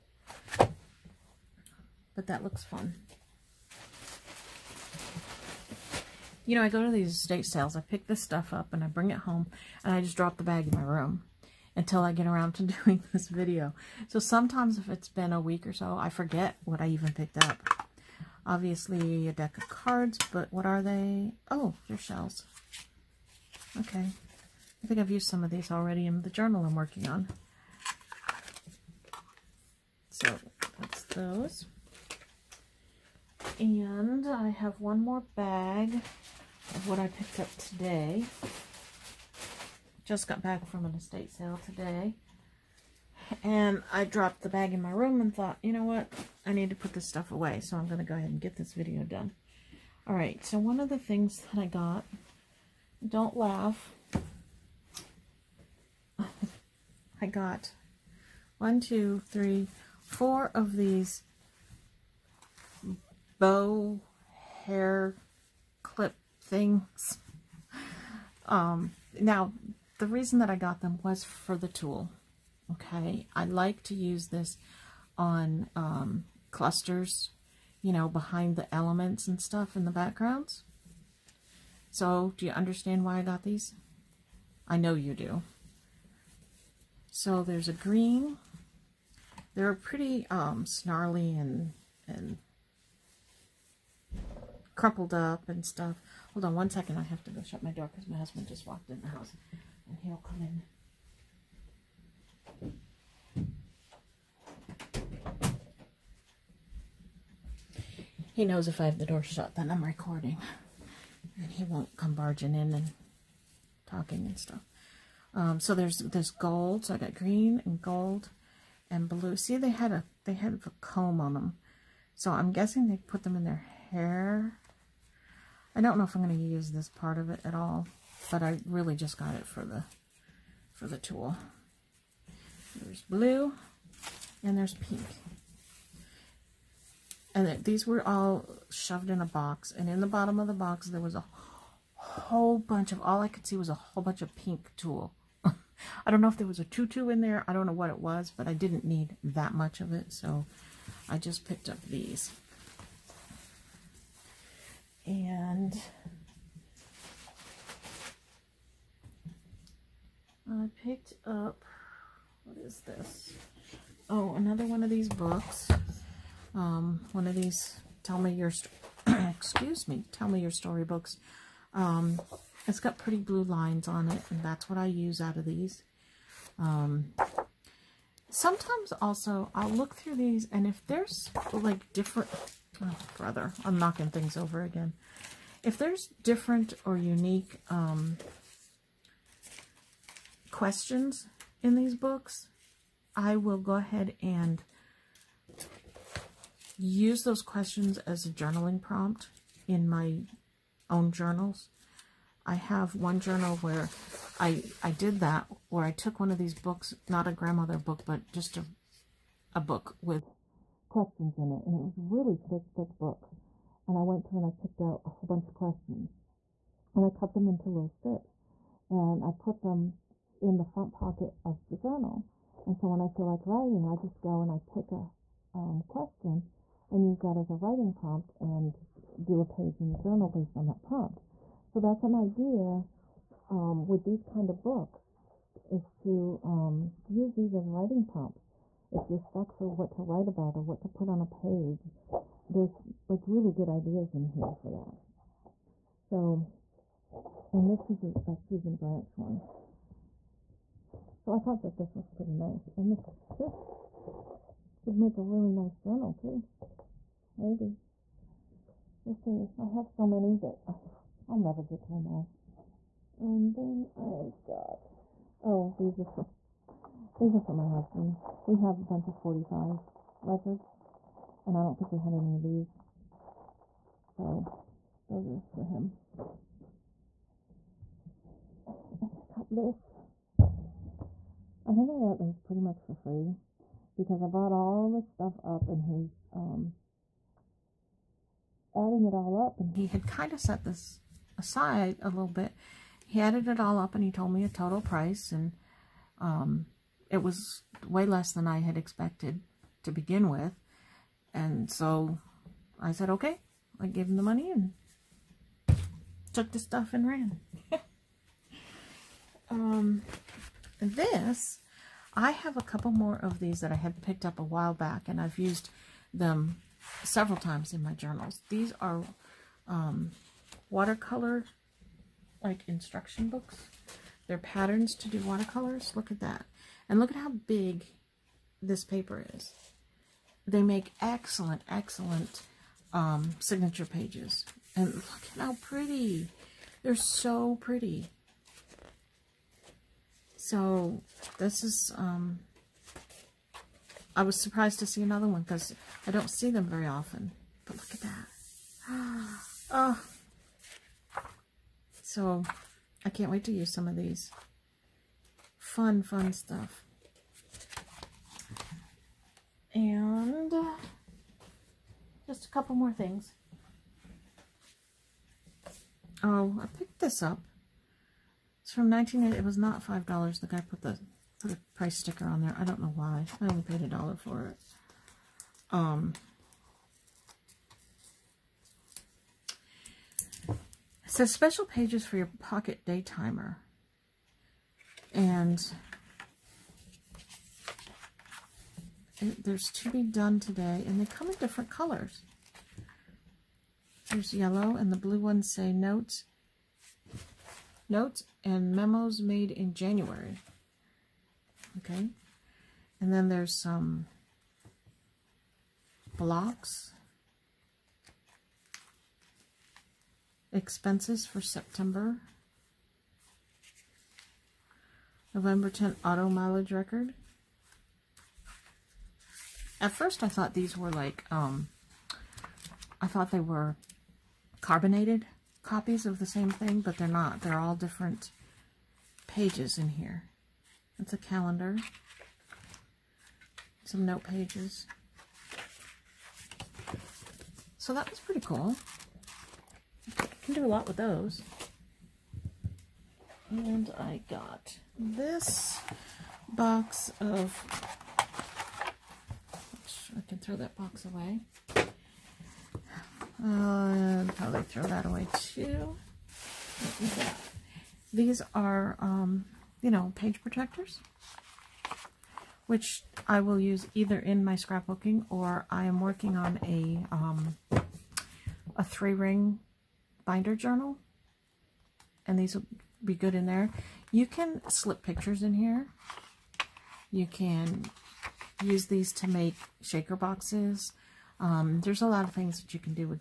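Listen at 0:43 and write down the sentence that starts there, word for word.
And I dropped the bag in my room and thought, you know what?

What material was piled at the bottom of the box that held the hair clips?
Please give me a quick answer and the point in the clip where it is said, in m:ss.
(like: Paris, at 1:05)
Pink tulle, at 2:24.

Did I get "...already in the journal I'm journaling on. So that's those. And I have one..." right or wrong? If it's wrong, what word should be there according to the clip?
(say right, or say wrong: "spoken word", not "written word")
wrong: "working", not "journaling".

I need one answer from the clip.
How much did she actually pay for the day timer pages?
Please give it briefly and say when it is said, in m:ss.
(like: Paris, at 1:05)
A dollar, at 6:13.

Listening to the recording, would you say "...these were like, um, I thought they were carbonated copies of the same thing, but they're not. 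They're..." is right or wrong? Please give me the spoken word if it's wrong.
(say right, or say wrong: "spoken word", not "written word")
right.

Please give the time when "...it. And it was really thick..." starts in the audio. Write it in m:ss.
3:31.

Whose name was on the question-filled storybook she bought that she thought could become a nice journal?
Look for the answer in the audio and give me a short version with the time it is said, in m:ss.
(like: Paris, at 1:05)
Susan Branch, at 4:08.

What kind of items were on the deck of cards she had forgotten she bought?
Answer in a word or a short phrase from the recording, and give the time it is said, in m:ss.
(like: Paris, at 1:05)
Shells, at 0:21.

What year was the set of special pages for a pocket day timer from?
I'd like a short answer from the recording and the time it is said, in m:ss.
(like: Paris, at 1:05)
1980, at 6:08.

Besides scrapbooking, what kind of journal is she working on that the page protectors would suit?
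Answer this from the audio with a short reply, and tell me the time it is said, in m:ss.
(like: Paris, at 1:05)
Three ring binder journal, at 7:48.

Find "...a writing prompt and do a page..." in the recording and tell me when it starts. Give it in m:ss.
3:47.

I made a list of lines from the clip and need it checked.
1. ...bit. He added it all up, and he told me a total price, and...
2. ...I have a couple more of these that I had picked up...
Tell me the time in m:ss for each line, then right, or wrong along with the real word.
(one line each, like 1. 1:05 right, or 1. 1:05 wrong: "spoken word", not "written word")
1. 4:52 right
2. 5:12 right.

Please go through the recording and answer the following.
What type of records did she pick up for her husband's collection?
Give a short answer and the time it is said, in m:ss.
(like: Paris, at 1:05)
45 records, at 4:29.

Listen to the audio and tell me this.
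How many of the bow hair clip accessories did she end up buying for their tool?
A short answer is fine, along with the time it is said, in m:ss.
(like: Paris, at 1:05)
4, at 1:00.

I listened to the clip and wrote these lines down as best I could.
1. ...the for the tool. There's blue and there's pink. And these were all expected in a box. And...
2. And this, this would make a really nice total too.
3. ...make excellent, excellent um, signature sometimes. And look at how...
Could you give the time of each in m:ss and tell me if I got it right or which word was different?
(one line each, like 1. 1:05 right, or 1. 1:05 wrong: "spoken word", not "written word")
1. 2:09 wrong: "shoved", not "expected"
2. 4:12 wrong: "journal", not "total"
3. 5:30 wrong: "pages", not "sometimes".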